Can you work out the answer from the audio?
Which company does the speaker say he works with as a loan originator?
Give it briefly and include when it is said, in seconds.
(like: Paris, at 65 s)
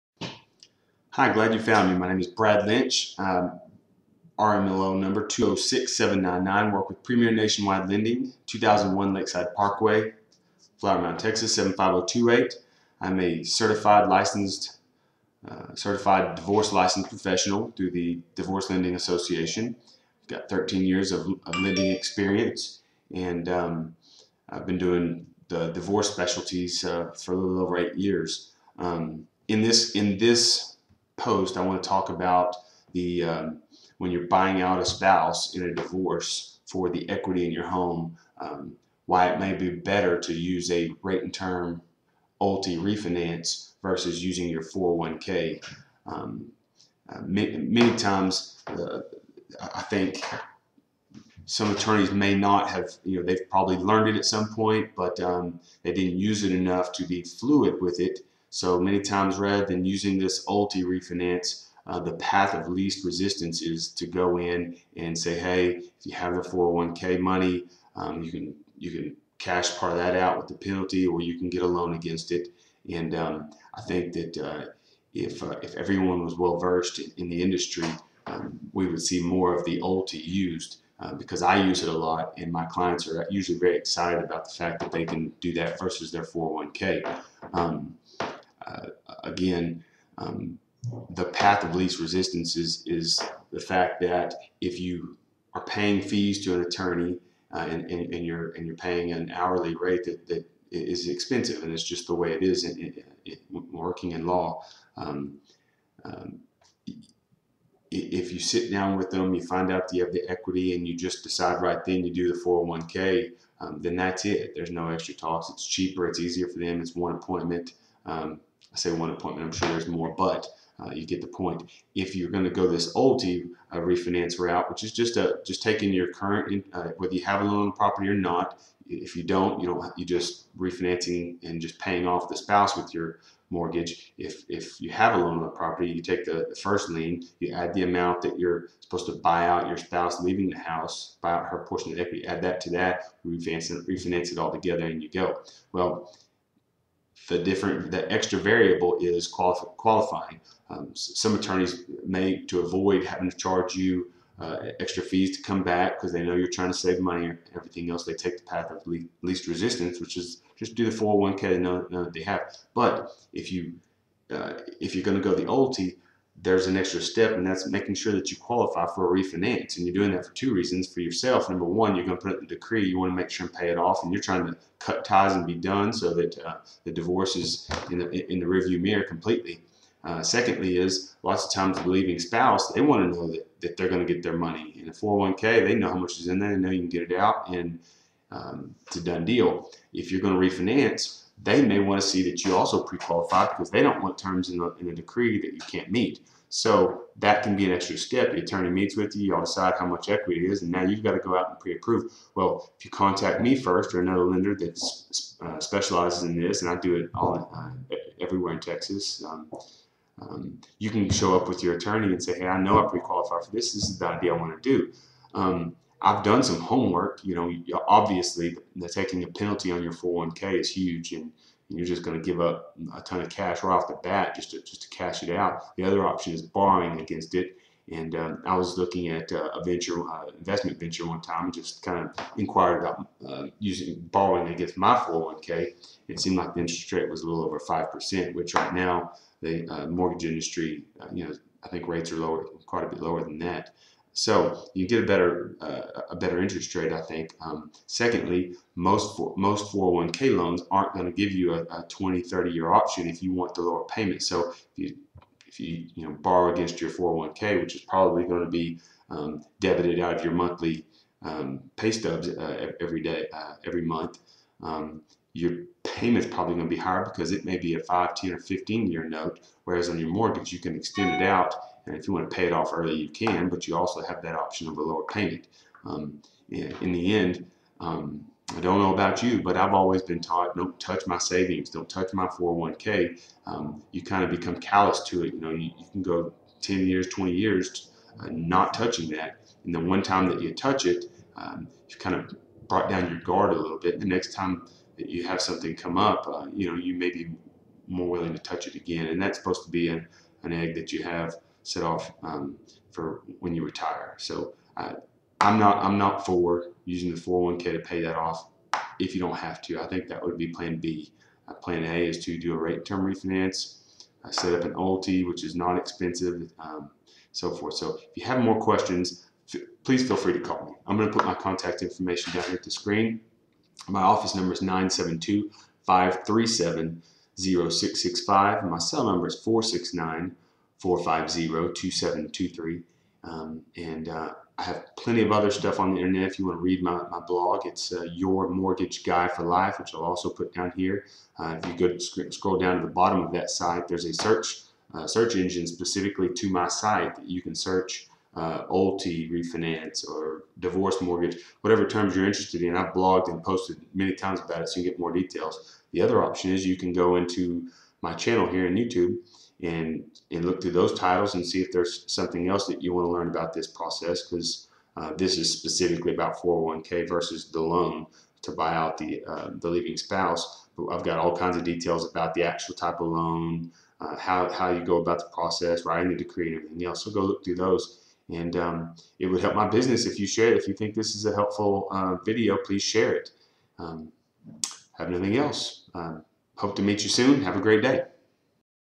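Premier Nationwide Lending, at 7 s.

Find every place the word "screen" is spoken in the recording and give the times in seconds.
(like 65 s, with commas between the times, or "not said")
322 s.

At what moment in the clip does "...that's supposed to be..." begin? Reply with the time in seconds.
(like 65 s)
299 s.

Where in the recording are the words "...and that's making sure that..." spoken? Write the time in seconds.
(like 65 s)
167 s.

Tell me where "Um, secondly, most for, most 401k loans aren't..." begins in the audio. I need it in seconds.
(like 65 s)
247 s.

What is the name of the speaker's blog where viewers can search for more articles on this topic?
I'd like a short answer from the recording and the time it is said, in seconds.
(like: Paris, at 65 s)
Your Mortgage Guy for Life, at 338 s.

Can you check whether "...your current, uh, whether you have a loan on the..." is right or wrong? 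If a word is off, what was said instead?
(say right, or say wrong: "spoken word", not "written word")
right.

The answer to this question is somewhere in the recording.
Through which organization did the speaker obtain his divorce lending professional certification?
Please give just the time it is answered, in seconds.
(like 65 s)
18 s.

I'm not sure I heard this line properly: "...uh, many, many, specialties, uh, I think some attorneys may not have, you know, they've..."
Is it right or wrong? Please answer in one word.
wrong.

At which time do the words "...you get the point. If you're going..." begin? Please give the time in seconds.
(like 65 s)
120 s.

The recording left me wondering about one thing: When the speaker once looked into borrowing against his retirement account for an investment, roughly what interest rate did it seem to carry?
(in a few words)
a little over 5%.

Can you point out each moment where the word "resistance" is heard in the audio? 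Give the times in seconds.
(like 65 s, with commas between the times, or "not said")
63 s, 91 s, 159 s.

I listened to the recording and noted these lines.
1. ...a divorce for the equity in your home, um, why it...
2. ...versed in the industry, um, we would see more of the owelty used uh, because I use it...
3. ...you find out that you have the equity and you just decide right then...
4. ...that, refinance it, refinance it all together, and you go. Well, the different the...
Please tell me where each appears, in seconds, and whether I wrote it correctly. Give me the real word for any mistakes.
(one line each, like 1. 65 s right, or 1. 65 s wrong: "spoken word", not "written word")
1. 35 s right
2. 76 s right
3. 109 s right
4. 142 s right.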